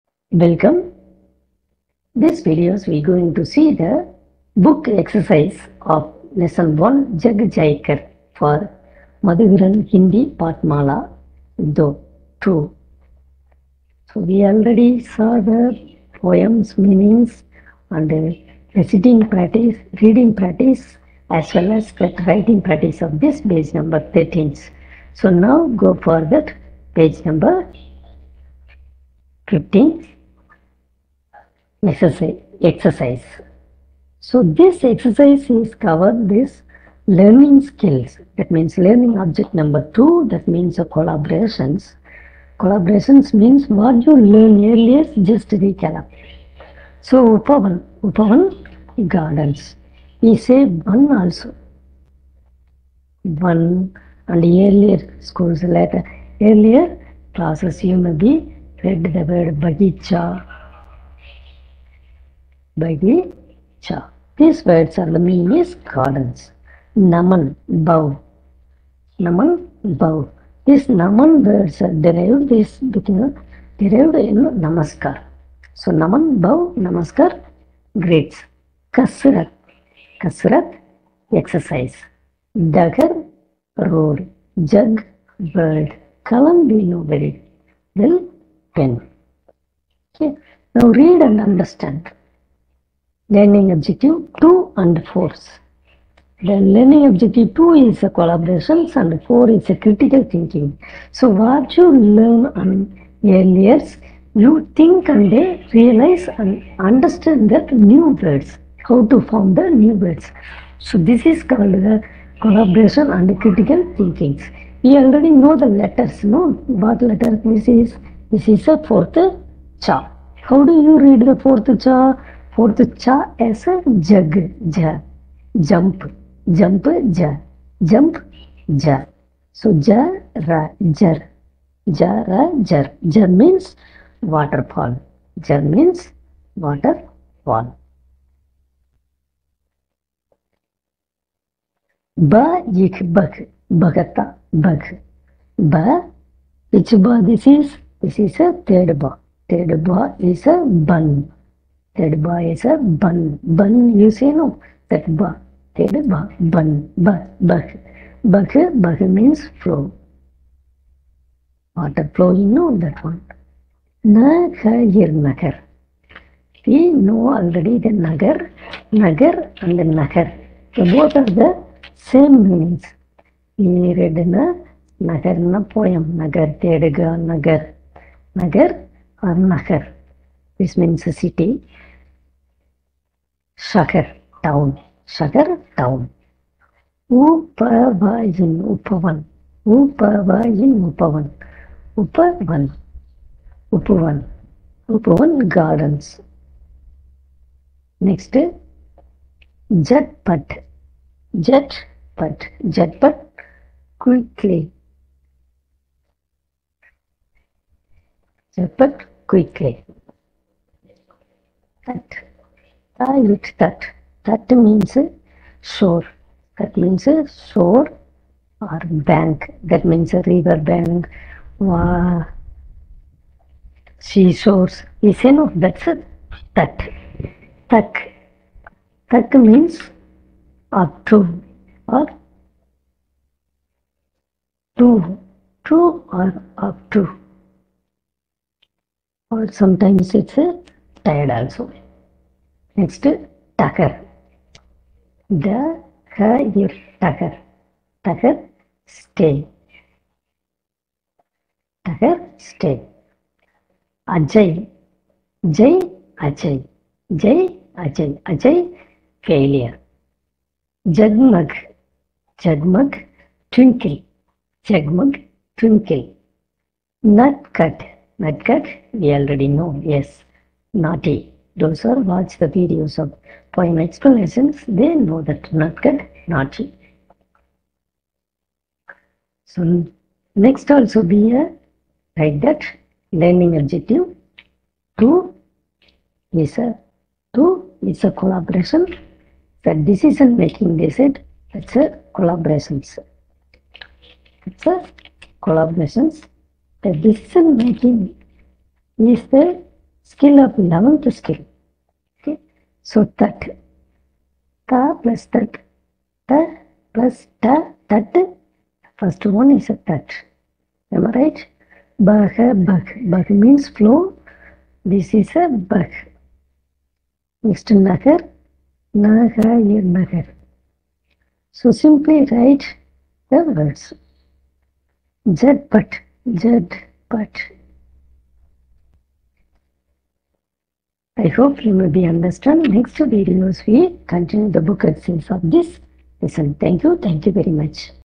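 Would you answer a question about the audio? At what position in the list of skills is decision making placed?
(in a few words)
11th.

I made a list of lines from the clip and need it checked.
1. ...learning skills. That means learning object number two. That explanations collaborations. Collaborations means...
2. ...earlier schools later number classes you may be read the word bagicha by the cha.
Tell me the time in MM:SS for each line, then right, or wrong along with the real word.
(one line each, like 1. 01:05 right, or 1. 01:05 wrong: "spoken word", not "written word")
1. 00:37 wrong: "means", not "explanations"
2. 00:54 wrong: "earlier", not "number".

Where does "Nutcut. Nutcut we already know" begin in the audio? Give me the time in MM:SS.
04:27.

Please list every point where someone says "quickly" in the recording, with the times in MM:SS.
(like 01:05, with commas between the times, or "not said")
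03:24, 03:29.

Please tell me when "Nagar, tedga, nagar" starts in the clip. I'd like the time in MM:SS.
02:56.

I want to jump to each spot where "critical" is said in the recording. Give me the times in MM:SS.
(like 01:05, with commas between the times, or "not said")
01:39, 01:53.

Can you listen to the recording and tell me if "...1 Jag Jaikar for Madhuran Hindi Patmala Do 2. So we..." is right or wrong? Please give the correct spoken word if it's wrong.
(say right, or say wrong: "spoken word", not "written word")
right.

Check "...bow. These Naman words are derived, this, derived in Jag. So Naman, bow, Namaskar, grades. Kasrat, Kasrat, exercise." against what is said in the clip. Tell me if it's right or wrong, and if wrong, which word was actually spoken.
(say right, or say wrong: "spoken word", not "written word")
wrong: "Namaskar", not "Jag".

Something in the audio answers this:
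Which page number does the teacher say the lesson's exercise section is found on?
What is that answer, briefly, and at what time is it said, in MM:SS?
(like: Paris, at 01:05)
15, at 00:26.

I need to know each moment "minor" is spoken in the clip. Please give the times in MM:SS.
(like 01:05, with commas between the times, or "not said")
not said.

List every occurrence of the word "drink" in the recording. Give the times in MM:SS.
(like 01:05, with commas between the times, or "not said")
not said.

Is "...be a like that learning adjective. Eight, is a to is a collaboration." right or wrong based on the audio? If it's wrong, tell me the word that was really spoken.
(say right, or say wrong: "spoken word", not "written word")
wrong: "Two", not "Eight".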